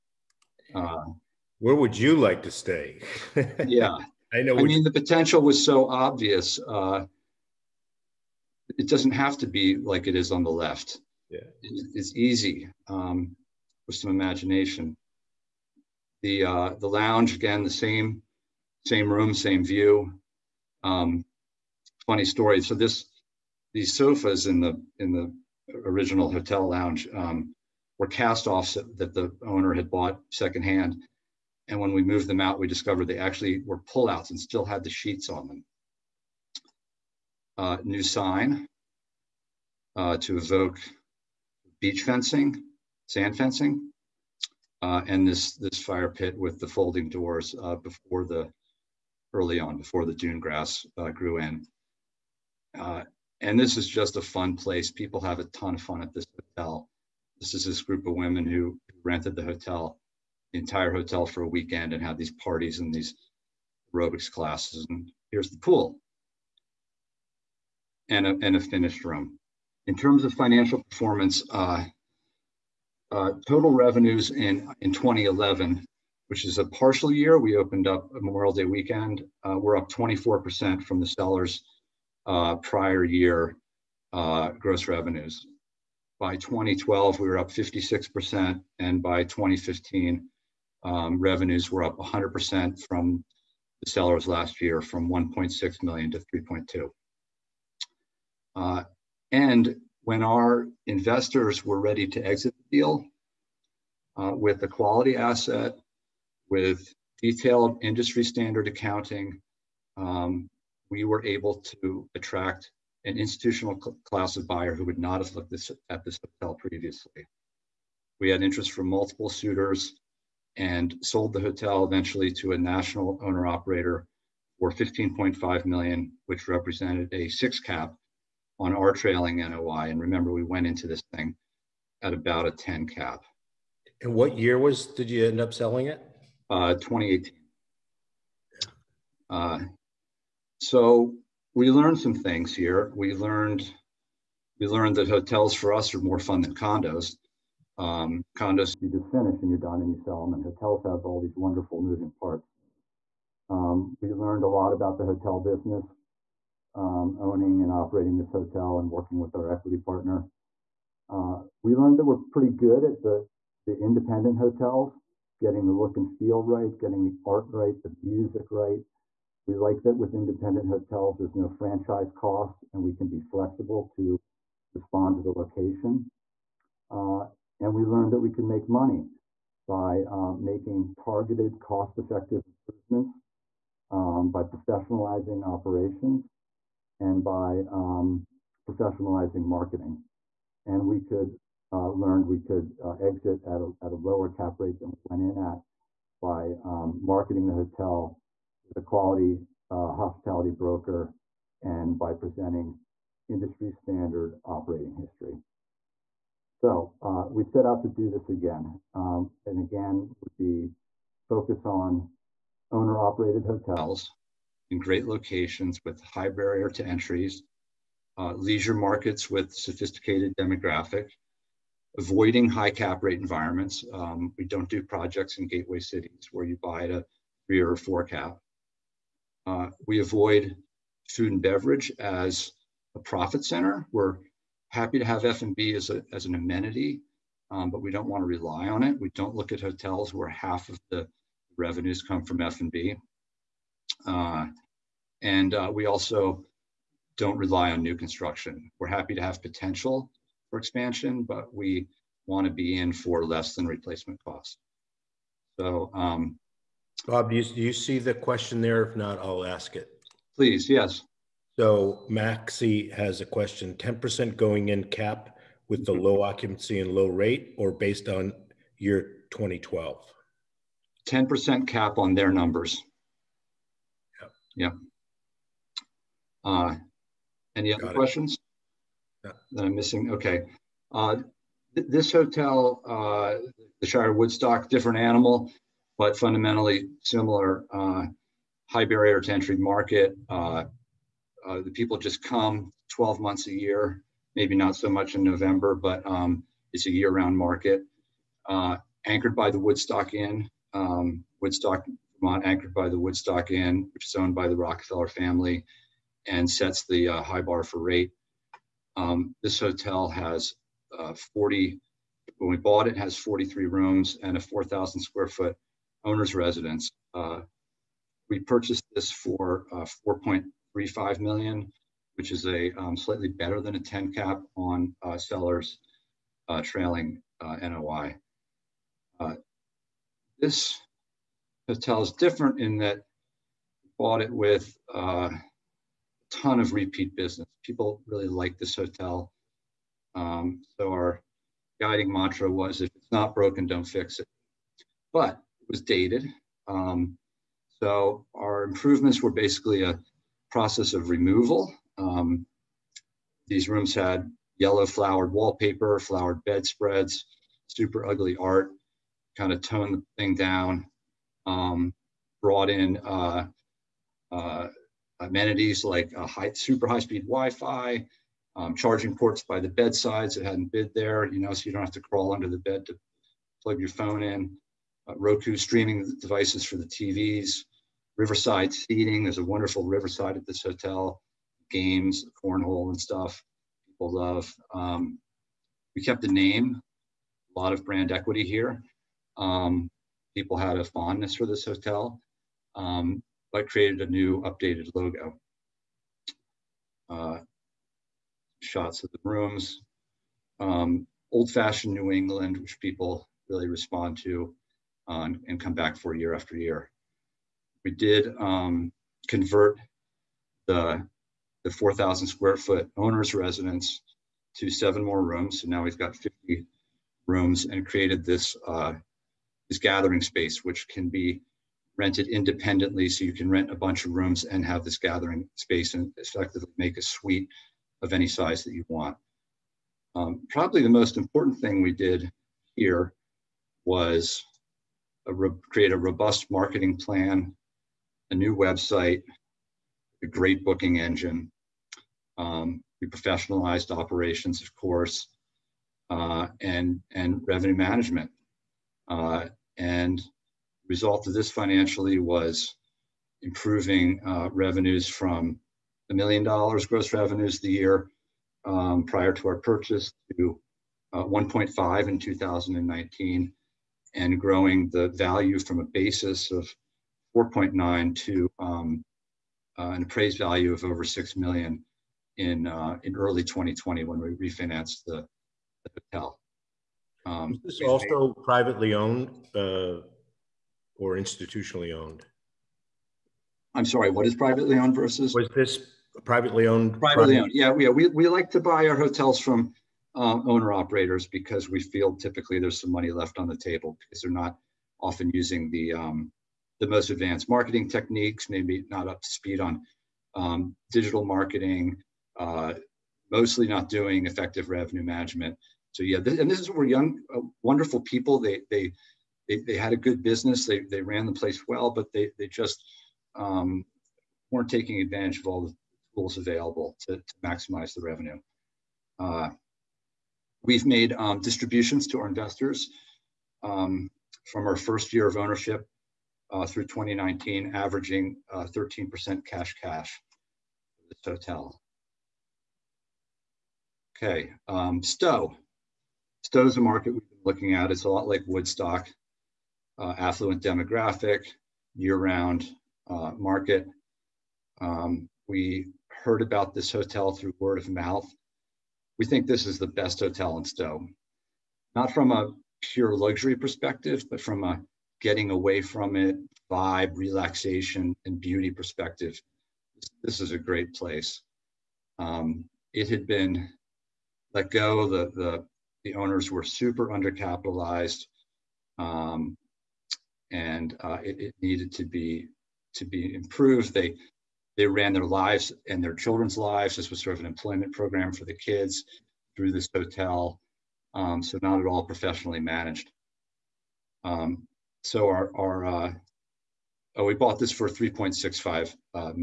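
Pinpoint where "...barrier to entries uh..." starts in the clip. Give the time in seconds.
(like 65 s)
216 s.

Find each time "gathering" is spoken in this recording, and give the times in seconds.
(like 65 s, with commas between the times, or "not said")
419 s, 424 s.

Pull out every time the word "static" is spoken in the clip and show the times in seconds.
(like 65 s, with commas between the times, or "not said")
not said.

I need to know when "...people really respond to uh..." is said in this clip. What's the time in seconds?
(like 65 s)
402 s.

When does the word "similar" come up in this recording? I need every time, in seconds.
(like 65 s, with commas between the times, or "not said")
287 s.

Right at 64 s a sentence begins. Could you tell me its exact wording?
And here's the pool and a, and a finished room.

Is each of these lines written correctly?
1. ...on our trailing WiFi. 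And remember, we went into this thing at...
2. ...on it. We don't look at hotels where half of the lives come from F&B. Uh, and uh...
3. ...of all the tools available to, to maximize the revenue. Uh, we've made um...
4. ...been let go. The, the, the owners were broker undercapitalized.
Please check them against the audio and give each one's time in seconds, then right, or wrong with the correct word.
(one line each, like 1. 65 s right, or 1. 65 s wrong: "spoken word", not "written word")
1. 128 s wrong: "NOI", not "WiFi"
2. 238 s wrong: "revenues", not "lives"
3. 515 s right
4. 563 s wrong: "super", not "broker".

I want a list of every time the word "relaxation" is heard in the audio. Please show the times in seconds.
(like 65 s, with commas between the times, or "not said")
557 s.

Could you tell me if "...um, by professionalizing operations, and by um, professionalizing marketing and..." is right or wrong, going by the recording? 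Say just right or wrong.
right.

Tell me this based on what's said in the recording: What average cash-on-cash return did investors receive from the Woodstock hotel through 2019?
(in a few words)
13%.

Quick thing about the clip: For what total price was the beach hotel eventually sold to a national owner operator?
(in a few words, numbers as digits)
15.5 million.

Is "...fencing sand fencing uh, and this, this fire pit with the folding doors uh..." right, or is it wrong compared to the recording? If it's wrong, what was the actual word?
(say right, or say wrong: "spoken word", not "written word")
right.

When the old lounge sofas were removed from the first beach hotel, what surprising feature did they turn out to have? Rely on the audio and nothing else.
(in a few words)
pullouts.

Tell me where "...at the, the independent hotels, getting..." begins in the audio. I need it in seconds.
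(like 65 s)
162 s.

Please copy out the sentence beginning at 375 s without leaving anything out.
Uh, Roku streaming devices for the TVs, riverside seating.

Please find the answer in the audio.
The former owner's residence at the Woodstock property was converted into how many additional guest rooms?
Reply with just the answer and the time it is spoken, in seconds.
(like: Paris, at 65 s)
7, at 414 s.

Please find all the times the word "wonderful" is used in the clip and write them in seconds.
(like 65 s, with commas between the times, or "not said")
151 s, 379 s, 507 s.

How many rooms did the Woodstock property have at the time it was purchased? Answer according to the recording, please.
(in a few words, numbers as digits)
43.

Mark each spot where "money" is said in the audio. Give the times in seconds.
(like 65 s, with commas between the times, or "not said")
178 s, 492 s.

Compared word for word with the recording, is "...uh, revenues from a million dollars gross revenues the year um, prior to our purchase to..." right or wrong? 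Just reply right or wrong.
right.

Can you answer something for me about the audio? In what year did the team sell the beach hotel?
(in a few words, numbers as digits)
2018.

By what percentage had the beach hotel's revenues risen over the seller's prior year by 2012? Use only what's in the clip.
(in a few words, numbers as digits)
56%.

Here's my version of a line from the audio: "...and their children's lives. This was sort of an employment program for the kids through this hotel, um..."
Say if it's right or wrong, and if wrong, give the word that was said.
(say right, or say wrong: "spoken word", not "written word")
right.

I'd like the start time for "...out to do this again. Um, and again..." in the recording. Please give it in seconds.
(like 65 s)
207 s.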